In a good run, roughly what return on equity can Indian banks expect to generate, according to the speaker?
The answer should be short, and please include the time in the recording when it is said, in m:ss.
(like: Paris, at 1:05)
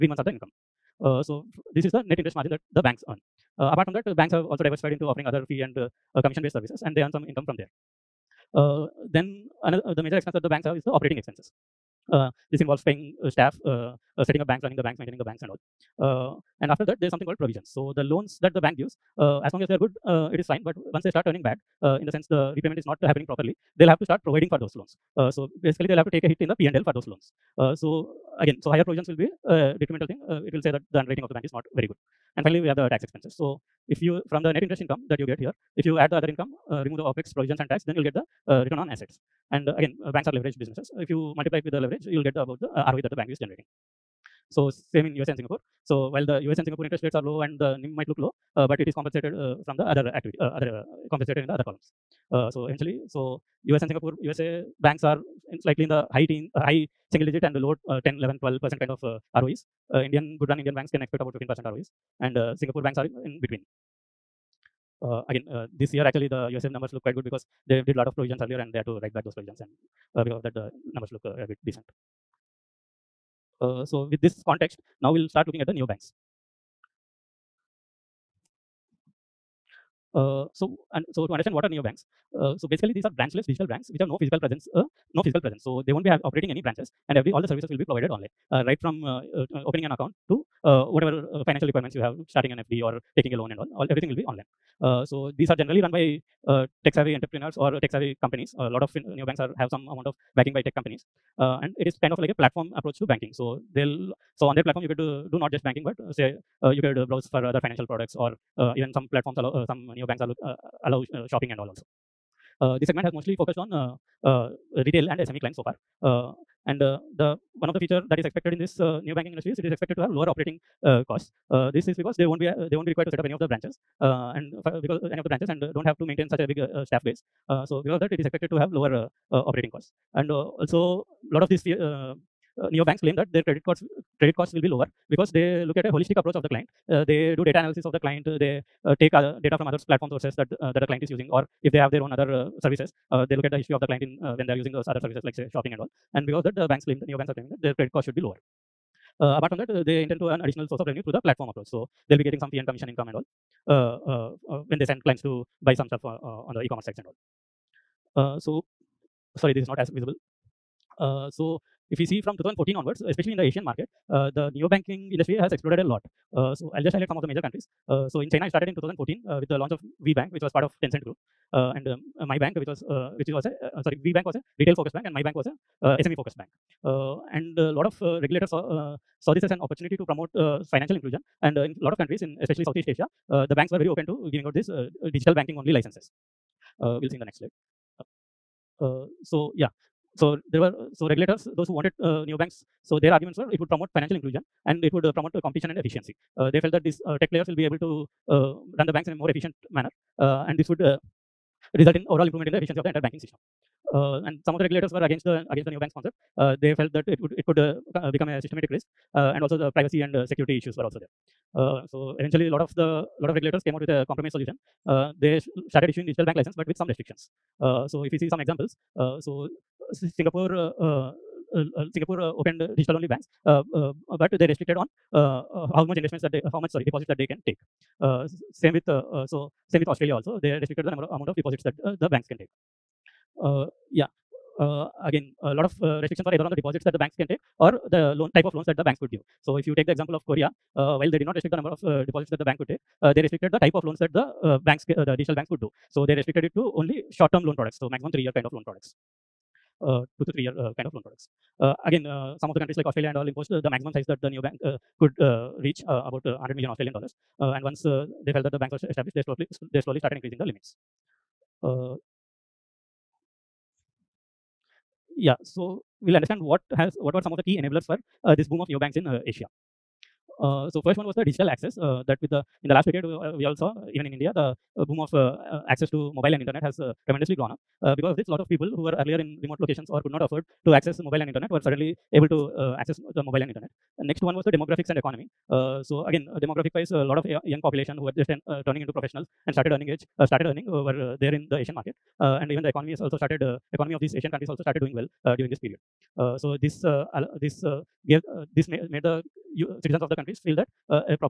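15 percent, at 1:01.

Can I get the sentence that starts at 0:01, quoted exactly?
so this is the net interest margin that the banks earn.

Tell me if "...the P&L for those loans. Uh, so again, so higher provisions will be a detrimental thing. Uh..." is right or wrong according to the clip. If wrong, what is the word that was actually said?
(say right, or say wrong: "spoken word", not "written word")
right.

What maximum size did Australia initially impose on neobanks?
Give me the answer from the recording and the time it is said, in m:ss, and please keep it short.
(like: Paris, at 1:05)
100 million Australian dollars, at 4:16.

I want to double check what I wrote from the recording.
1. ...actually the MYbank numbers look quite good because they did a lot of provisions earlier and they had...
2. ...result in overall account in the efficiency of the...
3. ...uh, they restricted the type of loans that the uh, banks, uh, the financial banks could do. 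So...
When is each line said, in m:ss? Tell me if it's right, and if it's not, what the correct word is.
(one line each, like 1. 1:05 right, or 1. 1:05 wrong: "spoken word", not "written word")
1. 1:06 wrong: "USF", not "MYbank"
2. 3:21 wrong: "improvement", not "account"
3. 4:03 wrong: "digital", not "financial".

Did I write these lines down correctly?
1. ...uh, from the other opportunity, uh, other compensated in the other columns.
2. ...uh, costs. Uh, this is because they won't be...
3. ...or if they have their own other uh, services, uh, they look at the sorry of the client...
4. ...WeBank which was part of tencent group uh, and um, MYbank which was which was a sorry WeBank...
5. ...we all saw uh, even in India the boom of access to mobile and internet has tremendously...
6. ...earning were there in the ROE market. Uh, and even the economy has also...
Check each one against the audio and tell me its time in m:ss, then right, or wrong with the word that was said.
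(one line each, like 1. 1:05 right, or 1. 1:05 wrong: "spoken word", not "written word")
1. 0:49 wrong: "activity", not "opportunity"
2. 2:00 right
3. 2:21 wrong: "history", not "sorry"
4. 2:50 right
5. 4:33 right
6. 4:50 wrong: "Asian", not "ROE".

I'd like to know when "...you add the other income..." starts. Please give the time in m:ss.
0:35.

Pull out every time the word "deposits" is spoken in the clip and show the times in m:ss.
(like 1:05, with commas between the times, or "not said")
3:46, 3:51, 3:56, 4:02.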